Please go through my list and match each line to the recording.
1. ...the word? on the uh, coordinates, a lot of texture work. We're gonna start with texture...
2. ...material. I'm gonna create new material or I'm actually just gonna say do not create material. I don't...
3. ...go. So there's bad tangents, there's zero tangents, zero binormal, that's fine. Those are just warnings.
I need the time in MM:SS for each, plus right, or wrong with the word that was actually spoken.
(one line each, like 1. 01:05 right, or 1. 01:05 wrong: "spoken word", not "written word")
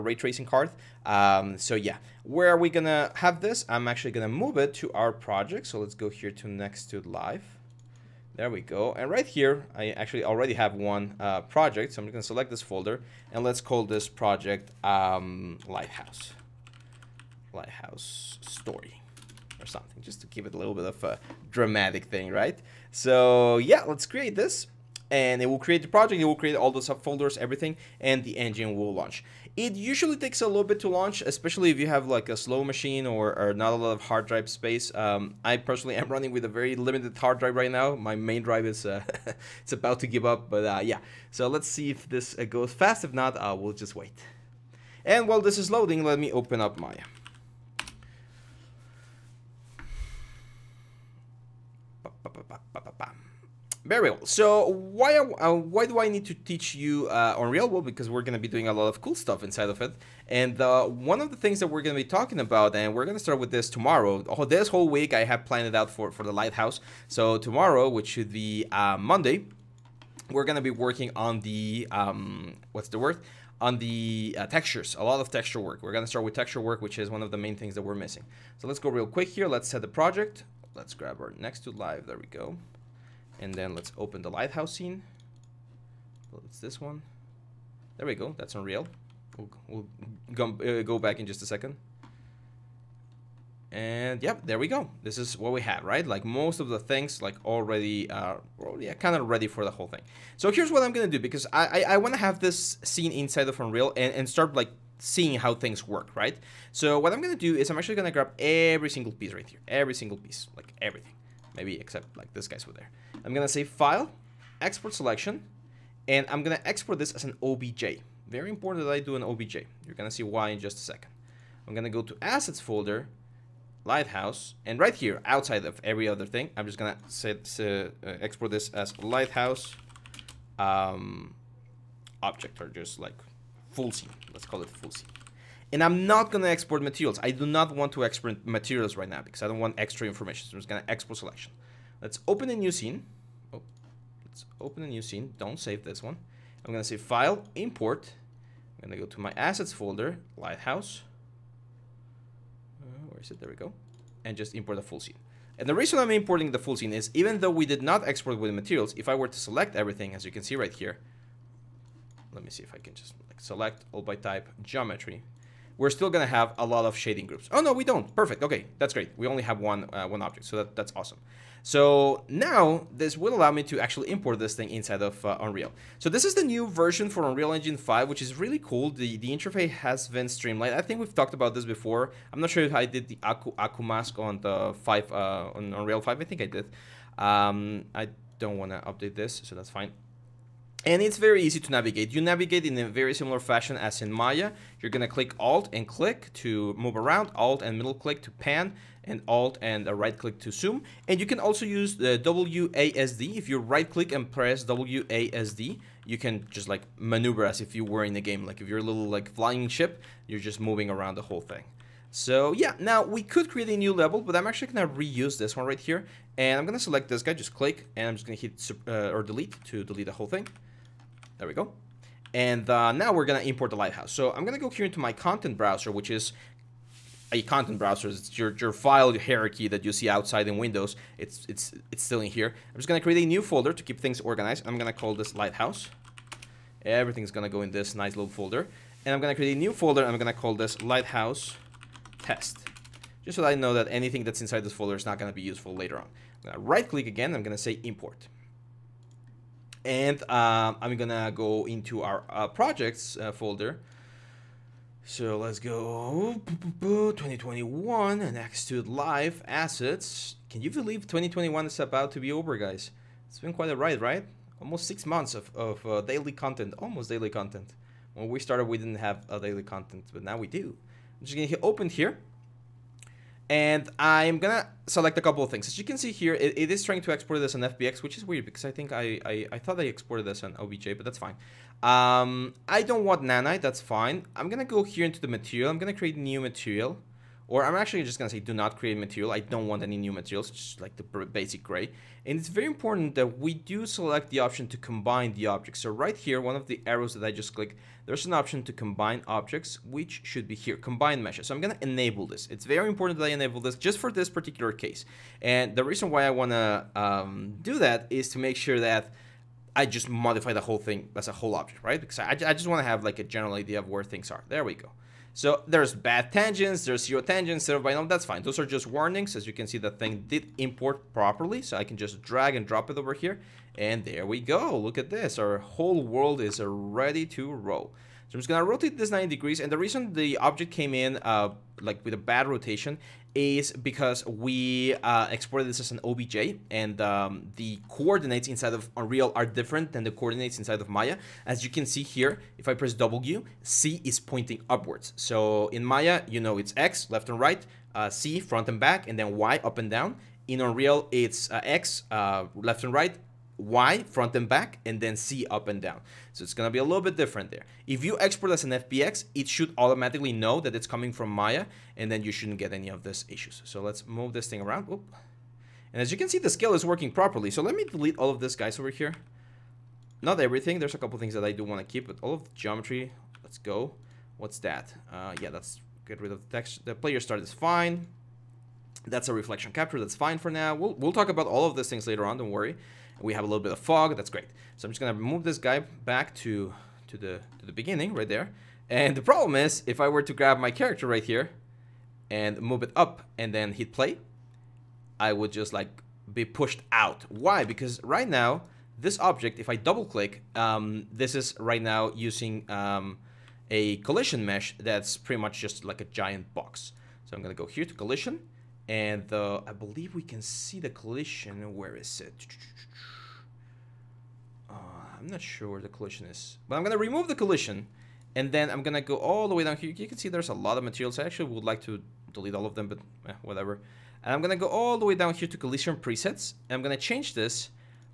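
1. 01:12 wrong: "textures", not "coordinates"
2. 04:45 right
3. 05:14 right.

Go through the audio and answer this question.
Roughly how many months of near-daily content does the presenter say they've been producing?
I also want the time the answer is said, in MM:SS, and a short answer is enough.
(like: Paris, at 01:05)
6, at 04:24.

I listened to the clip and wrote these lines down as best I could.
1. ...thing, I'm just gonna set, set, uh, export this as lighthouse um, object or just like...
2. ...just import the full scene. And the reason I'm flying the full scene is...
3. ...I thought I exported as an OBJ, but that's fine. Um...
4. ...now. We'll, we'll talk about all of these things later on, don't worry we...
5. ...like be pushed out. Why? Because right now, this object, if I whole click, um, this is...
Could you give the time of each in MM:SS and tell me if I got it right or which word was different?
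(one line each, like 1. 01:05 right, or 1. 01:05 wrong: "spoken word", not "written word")
1. 02:06 right
2. 02:34 wrong: "importing", not "flying"
3. 04:39 right
4. 06:20 right
5. 06:35 wrong: "double", not "whole".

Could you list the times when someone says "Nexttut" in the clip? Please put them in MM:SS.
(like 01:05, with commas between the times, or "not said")
00:06, 01:21.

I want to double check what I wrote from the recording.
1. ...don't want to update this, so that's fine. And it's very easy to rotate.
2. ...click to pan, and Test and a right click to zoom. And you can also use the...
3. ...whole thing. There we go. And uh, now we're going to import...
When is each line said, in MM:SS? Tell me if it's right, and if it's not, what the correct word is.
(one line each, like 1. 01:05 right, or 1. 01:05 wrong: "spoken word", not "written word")
1. 03:08 wrong: "navigate", not "rotate"
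2. 03:17 wrong: "Alt", not "Test"
3. 03:40 right.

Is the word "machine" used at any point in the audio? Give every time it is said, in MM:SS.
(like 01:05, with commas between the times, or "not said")
00:32.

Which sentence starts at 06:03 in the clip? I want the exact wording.
So let's move this thing around.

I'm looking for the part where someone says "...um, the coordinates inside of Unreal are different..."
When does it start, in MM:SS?
05:37.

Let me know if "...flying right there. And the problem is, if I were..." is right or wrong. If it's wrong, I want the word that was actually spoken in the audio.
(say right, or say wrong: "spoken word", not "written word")
wrong: "beginning", not "flying".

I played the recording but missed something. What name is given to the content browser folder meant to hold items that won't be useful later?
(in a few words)
Lighthouse Test.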